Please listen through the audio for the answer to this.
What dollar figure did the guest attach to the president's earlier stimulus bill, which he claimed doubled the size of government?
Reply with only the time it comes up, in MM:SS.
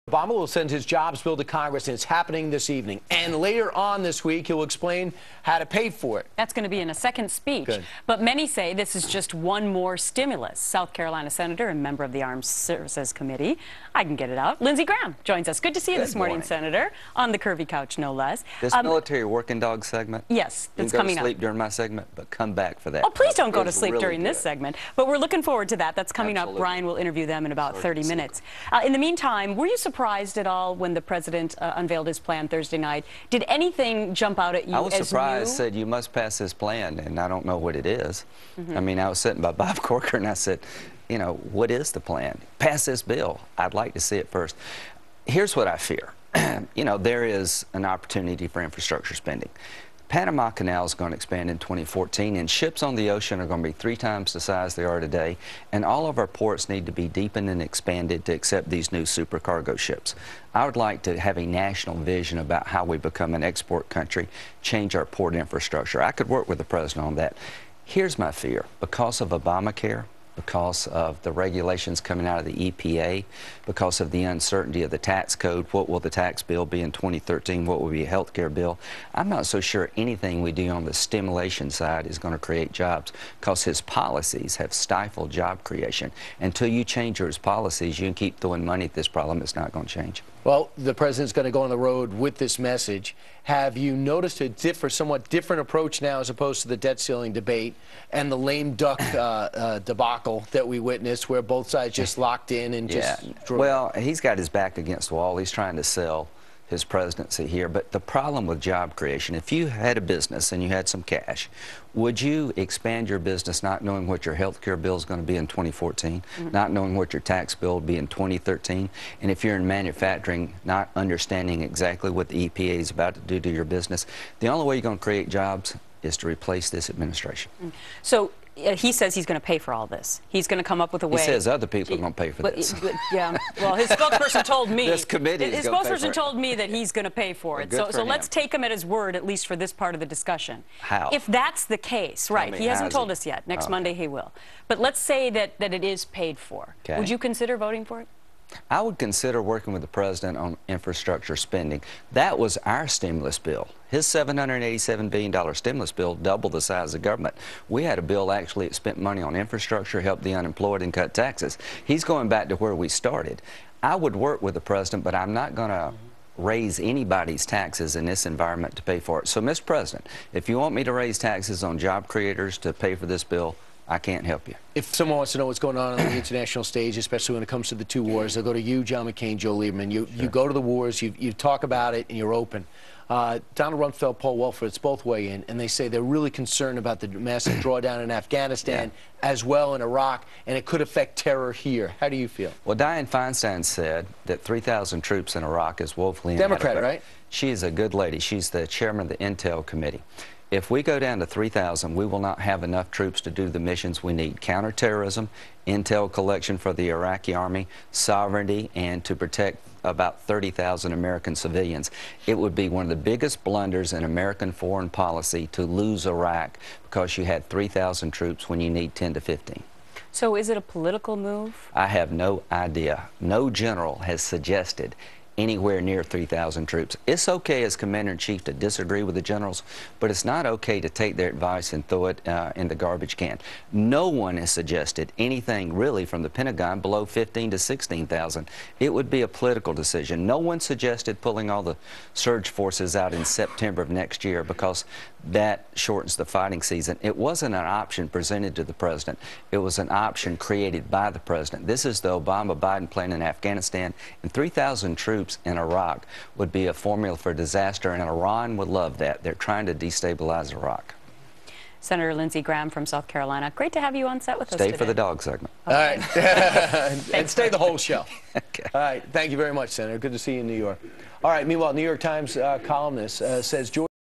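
02:34.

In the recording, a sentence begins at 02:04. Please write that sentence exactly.
The only way you're going to create jobs is to replace this administration.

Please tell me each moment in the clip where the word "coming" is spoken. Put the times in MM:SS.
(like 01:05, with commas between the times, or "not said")
00:20, 00:26, 01:11.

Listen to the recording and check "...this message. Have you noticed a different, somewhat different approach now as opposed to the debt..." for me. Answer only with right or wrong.
right.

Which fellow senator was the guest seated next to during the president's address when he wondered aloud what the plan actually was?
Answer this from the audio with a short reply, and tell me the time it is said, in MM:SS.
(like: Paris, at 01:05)
Bob Corker, at 00:39.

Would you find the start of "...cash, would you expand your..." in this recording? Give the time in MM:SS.
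01:51.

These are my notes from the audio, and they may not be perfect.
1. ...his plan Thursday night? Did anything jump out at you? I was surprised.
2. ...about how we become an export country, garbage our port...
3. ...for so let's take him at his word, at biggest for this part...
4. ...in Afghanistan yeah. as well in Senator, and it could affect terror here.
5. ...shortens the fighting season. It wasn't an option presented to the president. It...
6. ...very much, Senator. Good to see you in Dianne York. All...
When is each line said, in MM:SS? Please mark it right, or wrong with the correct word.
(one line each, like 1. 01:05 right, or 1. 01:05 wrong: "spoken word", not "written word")
1. 00:32 right
2. 01:02 wrong: "change", not "garbage"
3. 02:17 wrong: "least", not "biggest"
4. 03:08 wrong: "Iraq", not "Senator"
5. 04:05 right
6. 04:29 wrong: "New", not "Dianne".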